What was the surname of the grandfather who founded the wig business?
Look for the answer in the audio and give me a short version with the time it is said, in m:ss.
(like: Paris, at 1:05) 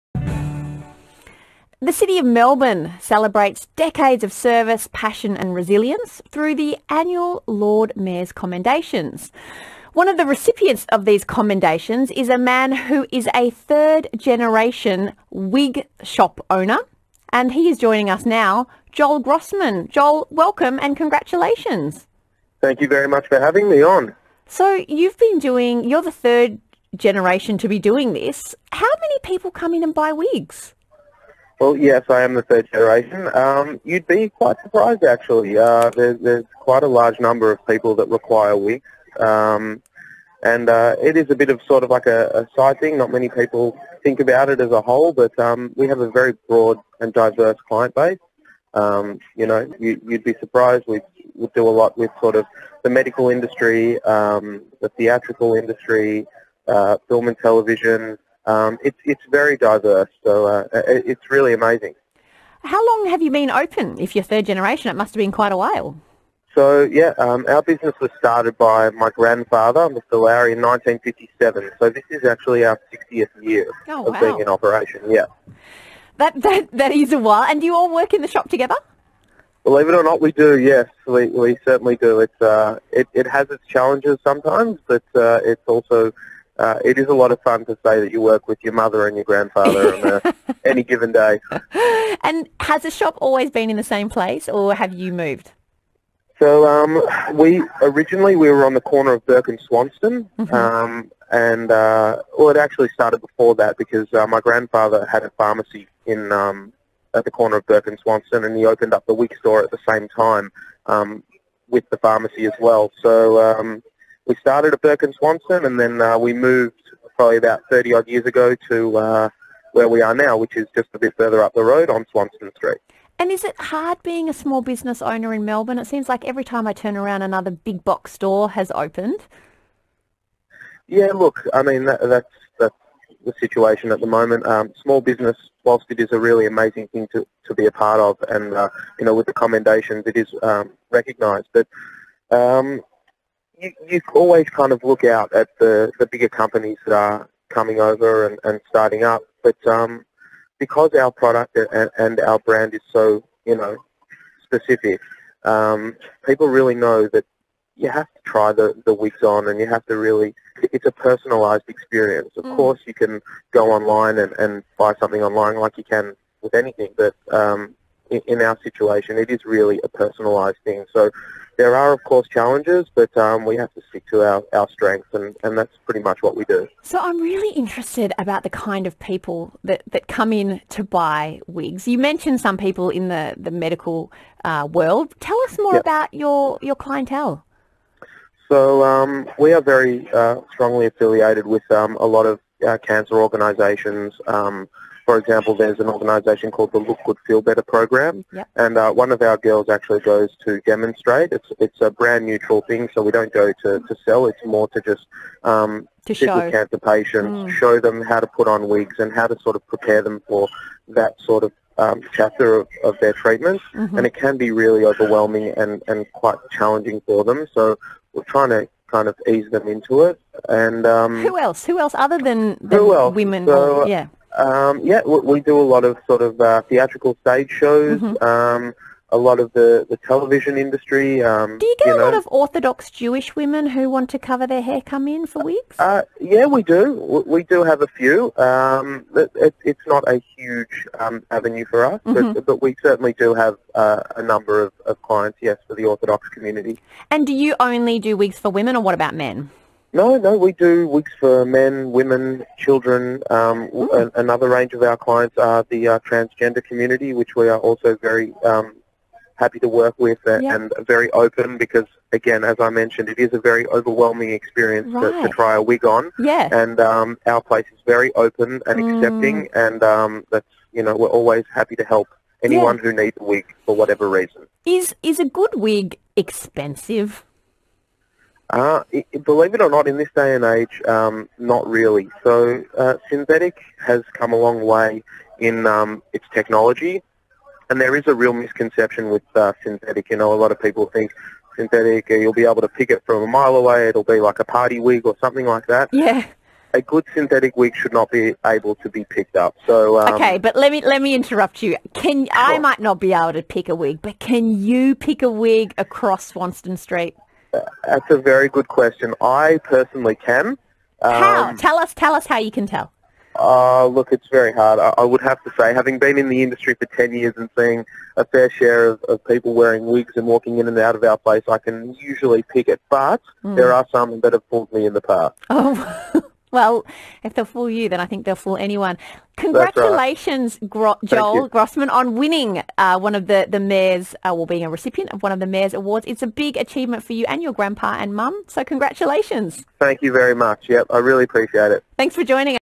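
Lowry, at 1:09.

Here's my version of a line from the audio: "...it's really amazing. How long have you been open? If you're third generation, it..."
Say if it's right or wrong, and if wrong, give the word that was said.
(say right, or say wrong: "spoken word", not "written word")
right.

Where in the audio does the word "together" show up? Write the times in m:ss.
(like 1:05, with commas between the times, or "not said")
1:18.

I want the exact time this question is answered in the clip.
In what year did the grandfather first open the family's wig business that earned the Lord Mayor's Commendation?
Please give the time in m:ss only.
1:10.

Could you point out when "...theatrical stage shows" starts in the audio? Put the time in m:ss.
3:46.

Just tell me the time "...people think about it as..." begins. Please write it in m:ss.
0:43.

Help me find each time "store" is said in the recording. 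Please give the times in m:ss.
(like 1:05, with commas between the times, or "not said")
1:49, 2:08.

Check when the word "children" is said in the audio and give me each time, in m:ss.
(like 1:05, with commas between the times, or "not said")
4:12.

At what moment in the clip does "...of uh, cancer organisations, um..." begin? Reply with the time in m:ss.
3:12.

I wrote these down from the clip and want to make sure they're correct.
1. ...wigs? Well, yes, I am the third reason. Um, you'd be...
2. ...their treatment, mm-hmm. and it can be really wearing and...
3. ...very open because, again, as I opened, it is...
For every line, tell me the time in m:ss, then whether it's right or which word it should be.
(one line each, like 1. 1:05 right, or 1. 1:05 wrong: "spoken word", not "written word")
1. 0:30 wrong: "generation", not "reason"
2. 3:33 wrong: "overwhelming", not "wearing"
3. 4:20 wrong: "mentioned", not "opened".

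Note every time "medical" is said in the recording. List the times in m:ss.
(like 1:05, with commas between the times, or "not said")
0:52, 3:03.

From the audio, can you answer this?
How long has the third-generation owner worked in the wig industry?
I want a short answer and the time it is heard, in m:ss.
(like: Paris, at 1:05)
10 years, at 5:16.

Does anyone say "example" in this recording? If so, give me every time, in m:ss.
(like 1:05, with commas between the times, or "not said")
3:15.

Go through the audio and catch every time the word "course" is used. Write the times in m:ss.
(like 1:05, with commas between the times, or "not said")
2:42, 2:52.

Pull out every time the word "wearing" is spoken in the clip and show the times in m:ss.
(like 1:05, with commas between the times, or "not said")
5:19.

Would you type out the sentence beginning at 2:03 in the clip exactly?
And is it hard being a small business owner in Melbourne?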